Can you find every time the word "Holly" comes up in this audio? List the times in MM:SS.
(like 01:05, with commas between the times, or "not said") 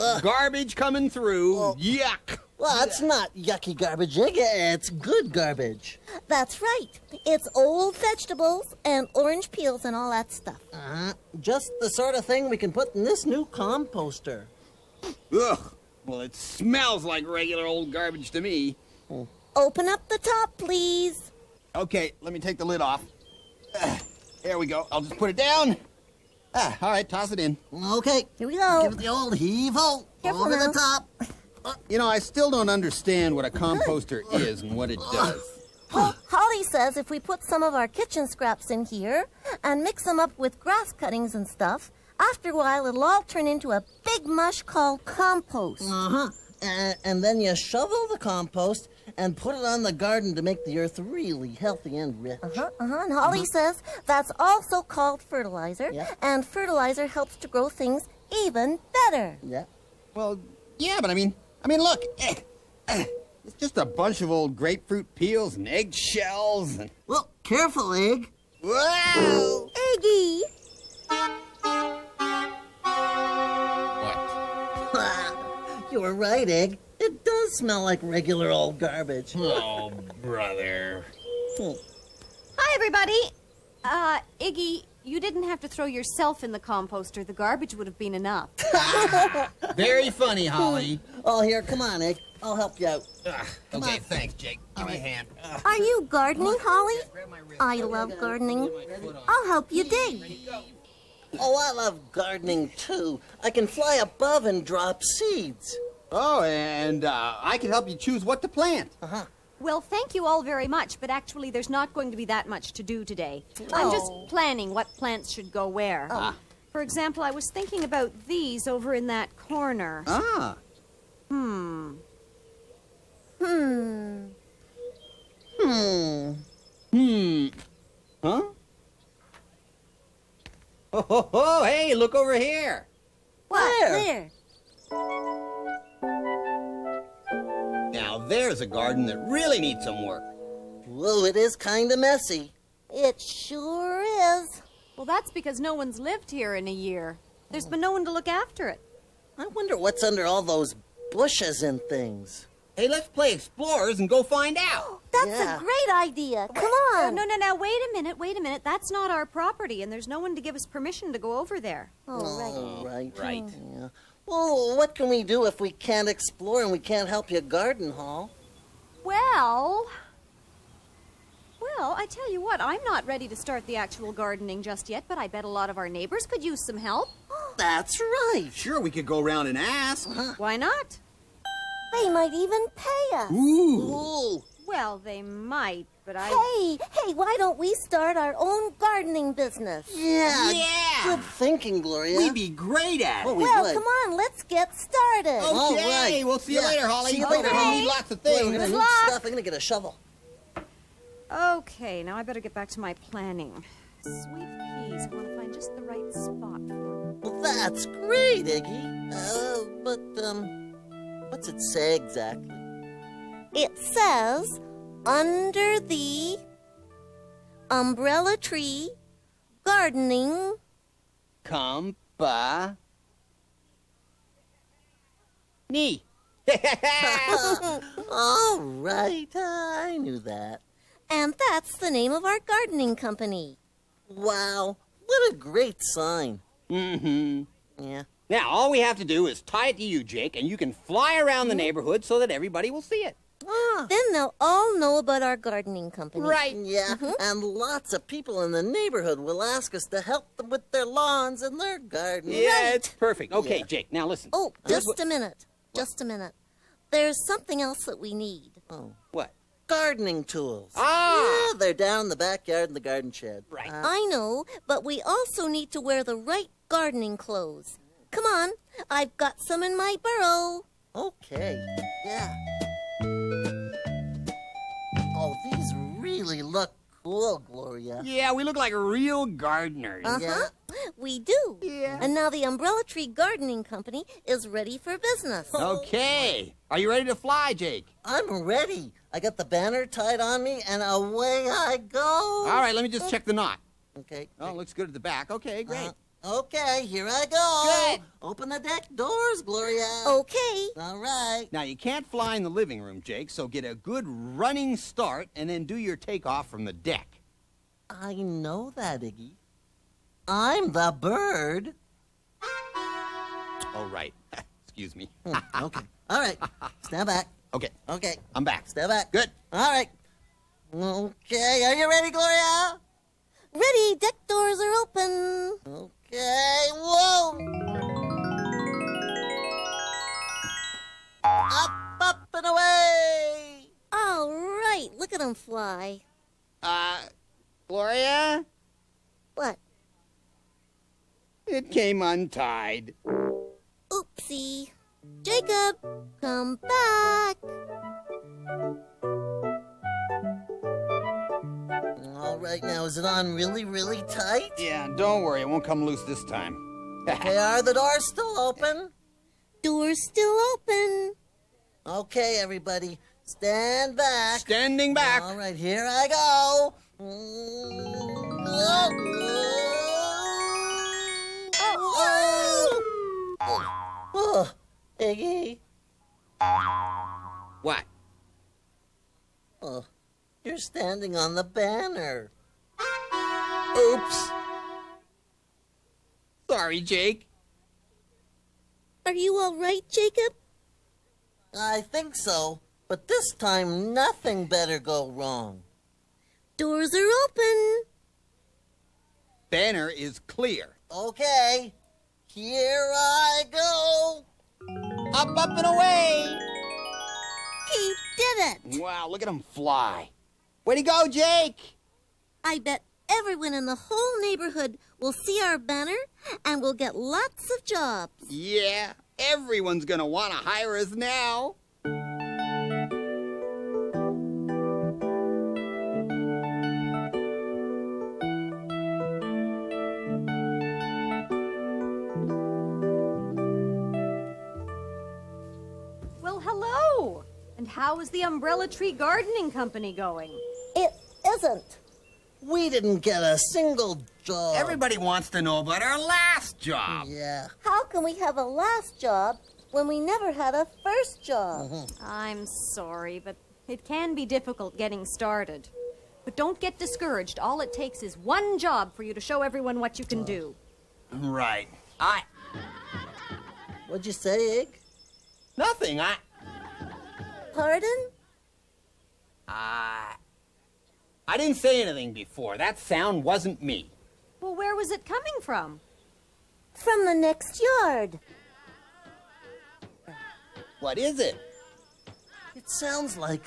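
00:53, 01:30, 01:36, 03:16.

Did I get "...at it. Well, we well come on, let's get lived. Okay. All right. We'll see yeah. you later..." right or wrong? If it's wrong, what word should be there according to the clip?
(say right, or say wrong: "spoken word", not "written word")
wrong: "started", not "lived".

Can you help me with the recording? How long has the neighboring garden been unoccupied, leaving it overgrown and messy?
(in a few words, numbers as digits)
a year.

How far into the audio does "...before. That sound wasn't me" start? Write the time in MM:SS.
07:52.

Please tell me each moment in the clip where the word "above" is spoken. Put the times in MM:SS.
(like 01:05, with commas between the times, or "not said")
01:44.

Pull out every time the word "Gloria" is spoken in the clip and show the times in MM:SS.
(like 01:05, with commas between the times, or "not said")
03:11, 04:37, 04:59, 05:22, 05:37.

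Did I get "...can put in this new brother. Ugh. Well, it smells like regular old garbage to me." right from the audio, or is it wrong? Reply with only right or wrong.
wrong.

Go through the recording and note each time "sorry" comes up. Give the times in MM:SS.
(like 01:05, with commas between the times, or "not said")
06:26, 07:32.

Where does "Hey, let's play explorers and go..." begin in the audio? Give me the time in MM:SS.
02:32.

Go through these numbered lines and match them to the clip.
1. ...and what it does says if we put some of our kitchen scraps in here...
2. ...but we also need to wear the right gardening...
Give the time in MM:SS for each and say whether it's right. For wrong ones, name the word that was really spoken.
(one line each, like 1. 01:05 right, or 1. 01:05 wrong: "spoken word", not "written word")
1. 00:34 right
2. 04:24 right.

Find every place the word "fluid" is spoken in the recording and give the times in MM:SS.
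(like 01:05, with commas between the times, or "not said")
not said.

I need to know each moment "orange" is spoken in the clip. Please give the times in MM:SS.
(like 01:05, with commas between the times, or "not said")
00:09.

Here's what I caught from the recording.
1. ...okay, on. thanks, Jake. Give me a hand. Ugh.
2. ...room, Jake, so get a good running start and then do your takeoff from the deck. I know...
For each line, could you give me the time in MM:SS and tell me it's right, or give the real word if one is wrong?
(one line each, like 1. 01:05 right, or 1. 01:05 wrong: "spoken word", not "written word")
1. 01:33 right
2. 05:02 right.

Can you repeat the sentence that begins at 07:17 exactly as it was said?
And how is the Umbrella Tree Gardening Company going?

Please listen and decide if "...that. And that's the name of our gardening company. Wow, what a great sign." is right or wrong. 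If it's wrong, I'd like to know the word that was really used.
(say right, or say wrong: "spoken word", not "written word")
right.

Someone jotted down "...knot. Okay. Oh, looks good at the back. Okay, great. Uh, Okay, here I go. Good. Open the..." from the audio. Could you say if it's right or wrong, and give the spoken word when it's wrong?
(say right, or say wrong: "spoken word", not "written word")
right.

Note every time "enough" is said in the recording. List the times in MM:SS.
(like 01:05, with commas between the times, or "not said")
01:28.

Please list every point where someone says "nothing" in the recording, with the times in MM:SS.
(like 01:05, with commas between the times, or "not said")
06:33, 07:45.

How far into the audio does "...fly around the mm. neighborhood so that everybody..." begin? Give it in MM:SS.
04:00.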